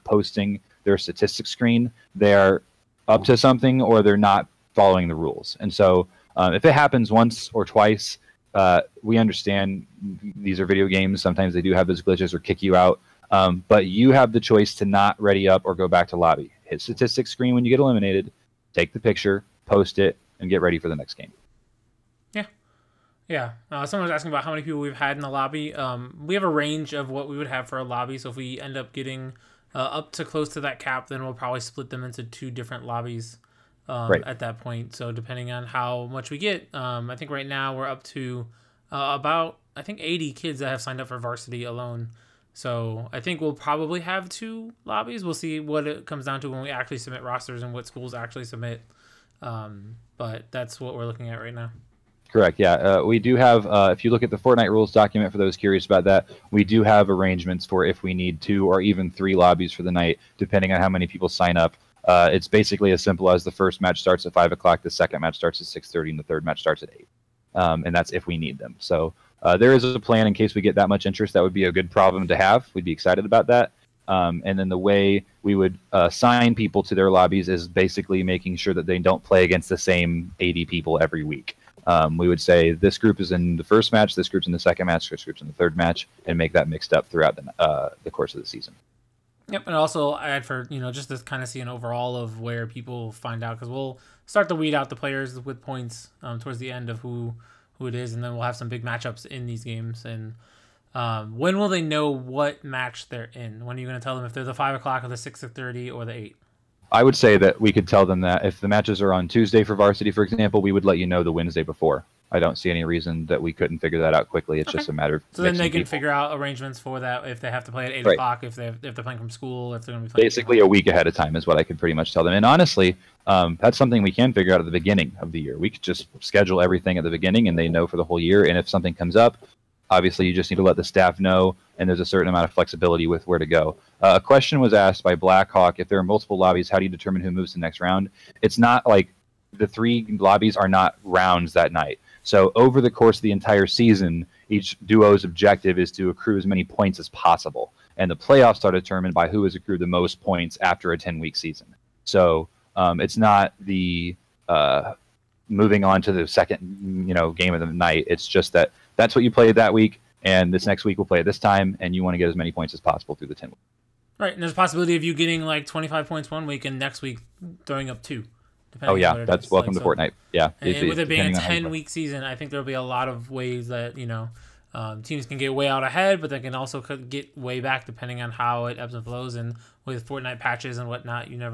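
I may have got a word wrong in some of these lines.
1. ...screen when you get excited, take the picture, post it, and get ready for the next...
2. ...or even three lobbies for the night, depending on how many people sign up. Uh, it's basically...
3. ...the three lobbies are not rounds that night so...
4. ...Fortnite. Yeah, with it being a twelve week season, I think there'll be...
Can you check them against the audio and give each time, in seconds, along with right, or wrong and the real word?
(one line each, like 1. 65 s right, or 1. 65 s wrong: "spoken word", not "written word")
1. 17 s wrong: "eliminated", not "excited"
2. 58 s right
3. 139 s right
4. 169 s wrong: "ten", not "twelve".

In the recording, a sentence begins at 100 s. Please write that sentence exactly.
And um, when will they know what match they're in?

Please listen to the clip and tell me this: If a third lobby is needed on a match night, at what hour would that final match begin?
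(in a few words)
8:00.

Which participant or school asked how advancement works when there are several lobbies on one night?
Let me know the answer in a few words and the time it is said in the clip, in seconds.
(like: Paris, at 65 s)
Blackhawk, at 135 s.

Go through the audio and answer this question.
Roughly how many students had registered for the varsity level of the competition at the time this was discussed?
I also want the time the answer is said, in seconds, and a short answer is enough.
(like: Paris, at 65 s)
80, at 39 s.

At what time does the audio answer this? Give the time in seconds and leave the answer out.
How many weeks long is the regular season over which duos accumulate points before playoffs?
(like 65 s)
150 s.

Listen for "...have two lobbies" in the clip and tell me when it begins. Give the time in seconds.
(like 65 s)
44 s.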